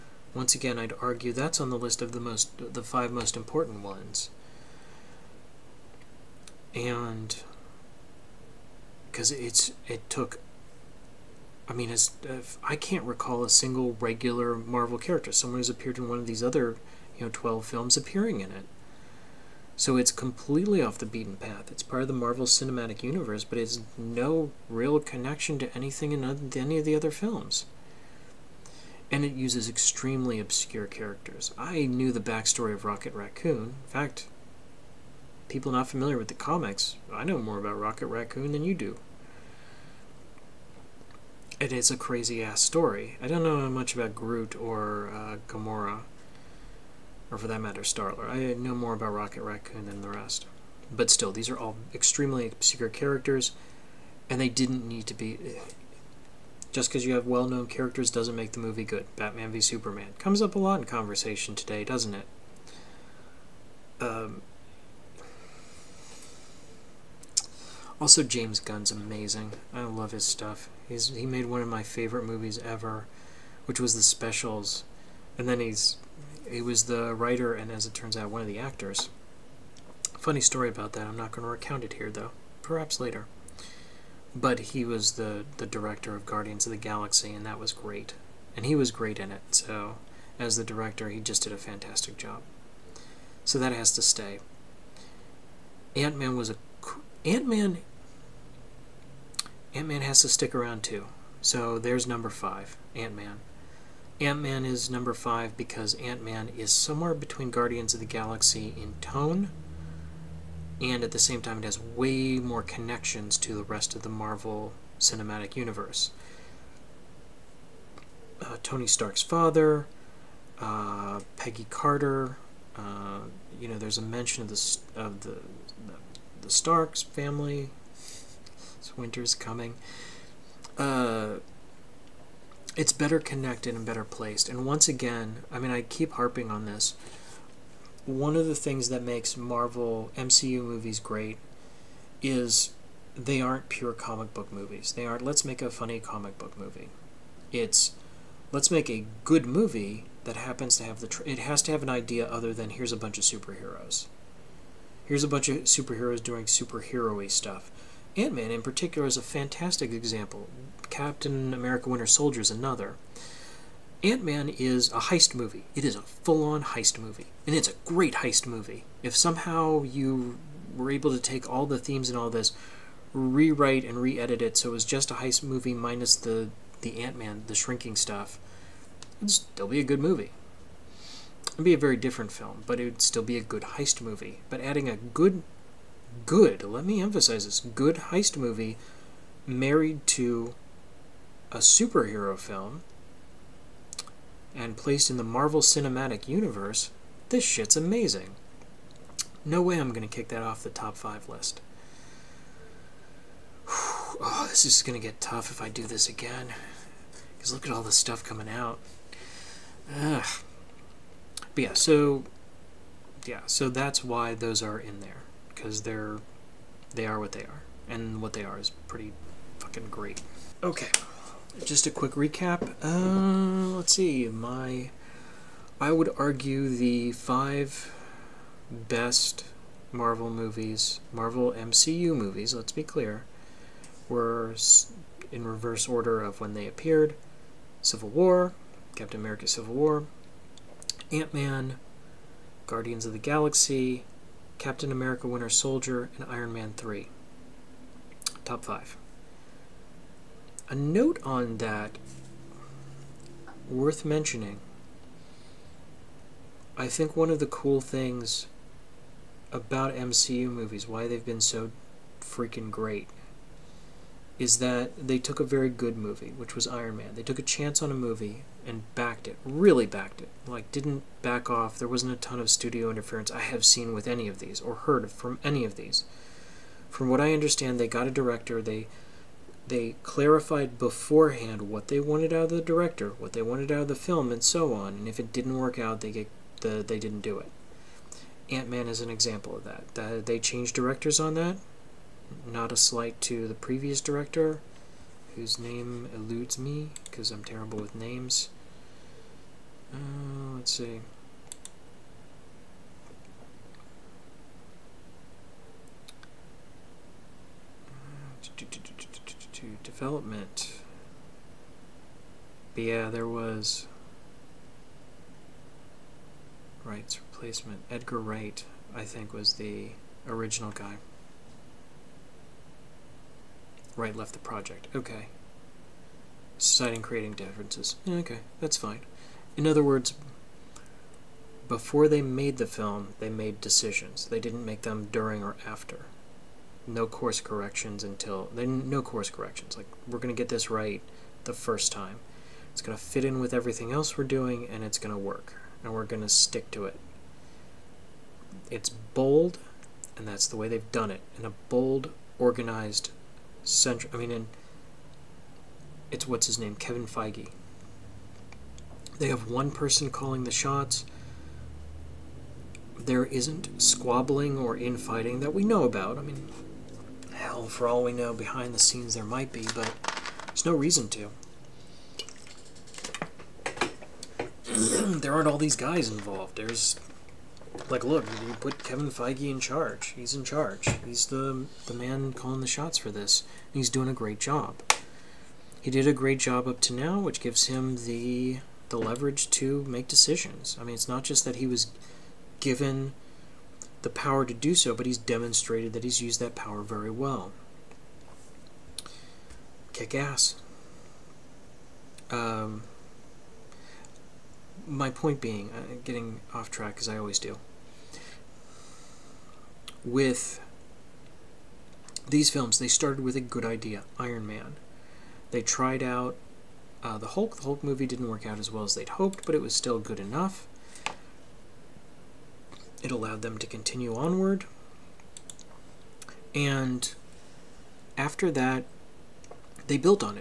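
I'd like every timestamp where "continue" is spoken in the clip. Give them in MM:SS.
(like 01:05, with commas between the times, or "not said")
07:03.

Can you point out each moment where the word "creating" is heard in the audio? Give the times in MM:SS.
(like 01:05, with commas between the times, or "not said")
05:27.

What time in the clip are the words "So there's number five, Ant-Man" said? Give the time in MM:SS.
01:41.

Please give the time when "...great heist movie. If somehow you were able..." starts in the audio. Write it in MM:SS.
02:47.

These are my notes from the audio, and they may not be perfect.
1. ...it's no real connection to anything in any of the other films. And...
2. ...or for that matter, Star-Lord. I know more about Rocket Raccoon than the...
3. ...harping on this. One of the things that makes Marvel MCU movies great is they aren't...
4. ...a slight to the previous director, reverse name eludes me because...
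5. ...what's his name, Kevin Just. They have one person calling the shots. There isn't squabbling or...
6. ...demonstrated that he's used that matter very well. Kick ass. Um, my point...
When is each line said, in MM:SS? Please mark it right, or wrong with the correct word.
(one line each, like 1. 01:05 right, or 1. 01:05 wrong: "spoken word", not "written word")
1. 00:23 right
2. 00:47 right
3. 02:16 right
4. 04:52 wrong: "whose", not "reverse"
5. 05:56 wrong: "Feige", not "Just"
6. 06:35 wrong: "power", not "matter".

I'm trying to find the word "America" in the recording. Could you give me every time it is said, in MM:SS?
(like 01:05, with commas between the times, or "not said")
02:41, 03:59, 04:04.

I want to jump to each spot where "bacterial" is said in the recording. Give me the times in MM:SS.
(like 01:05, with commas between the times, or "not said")
not said.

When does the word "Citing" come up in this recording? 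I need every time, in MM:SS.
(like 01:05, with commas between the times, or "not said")
05:26.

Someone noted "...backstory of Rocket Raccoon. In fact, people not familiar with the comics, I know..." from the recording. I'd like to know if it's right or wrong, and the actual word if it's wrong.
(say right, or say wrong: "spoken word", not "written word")
right.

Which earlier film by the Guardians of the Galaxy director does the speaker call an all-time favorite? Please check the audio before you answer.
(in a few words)
The Specials.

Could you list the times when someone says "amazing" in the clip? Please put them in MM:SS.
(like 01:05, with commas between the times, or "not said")
01:08, 03:17.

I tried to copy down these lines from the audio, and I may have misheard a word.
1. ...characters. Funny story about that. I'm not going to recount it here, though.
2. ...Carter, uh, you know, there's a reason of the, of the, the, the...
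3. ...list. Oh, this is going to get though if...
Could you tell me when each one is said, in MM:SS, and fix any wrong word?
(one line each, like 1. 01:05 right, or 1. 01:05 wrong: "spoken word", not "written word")
1. 01:18 wrong: "actors", not "characters"
2. 02:01 wrong: "mention", not "reason"
3. 03:21 wrong: "tough", not "though".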